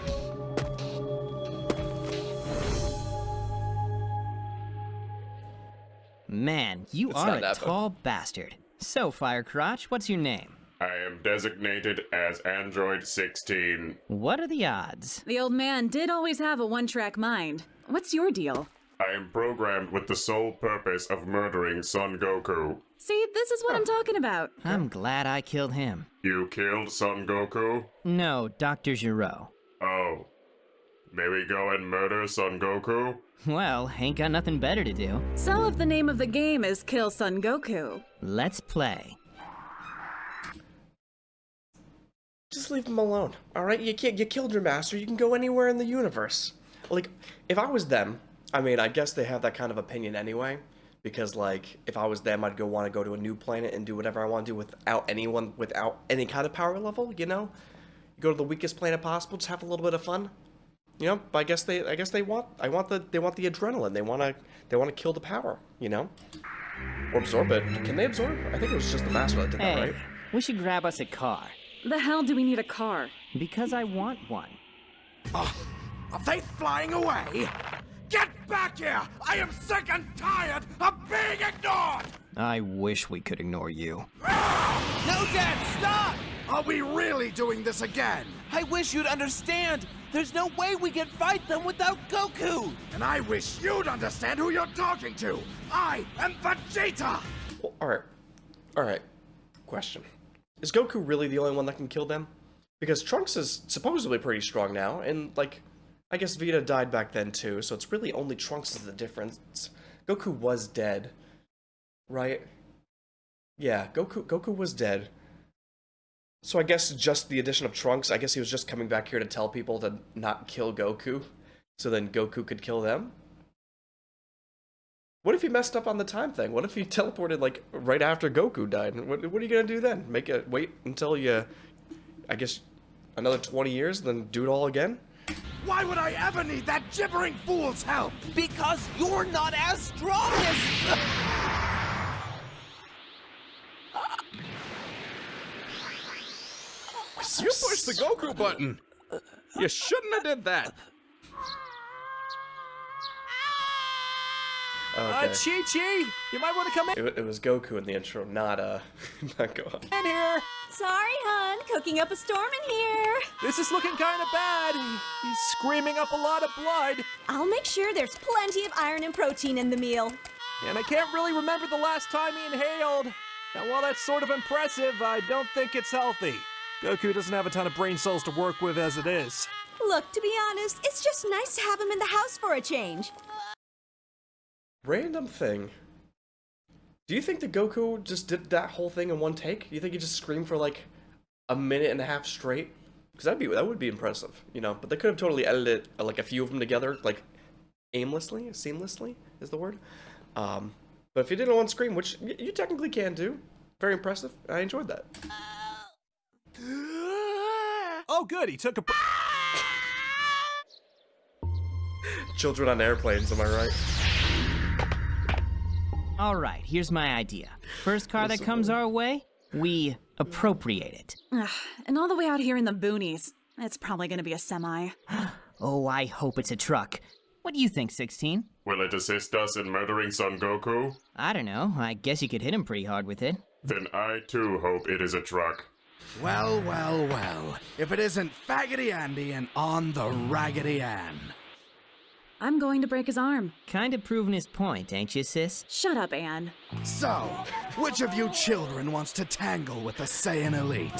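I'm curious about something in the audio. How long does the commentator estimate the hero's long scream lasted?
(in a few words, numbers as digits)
a minute and a half.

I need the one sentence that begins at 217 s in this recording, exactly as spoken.
First car that comes our way, we appropriate it.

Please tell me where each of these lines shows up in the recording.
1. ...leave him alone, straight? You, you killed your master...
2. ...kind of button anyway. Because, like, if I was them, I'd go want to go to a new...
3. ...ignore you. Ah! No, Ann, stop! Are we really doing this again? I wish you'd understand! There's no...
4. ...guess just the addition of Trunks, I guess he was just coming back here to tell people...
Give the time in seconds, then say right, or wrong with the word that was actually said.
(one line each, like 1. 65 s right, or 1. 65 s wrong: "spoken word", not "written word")
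1. 42 s wrong: "alright", not "straight"
2. 49 s wrong: "opinion", not "button"
3. 83 s wrong: "Dad", not "Ann"
4. 116 s right.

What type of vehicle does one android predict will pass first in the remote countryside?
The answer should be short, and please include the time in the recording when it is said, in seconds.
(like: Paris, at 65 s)
semi, at 224 s.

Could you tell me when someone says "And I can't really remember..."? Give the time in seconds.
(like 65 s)
170 s.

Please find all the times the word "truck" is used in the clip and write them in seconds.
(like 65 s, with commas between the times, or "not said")
226 s, 235 s.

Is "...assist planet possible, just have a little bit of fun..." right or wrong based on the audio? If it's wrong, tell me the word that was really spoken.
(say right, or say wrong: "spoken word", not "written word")
wrong: "weakest", not "assist".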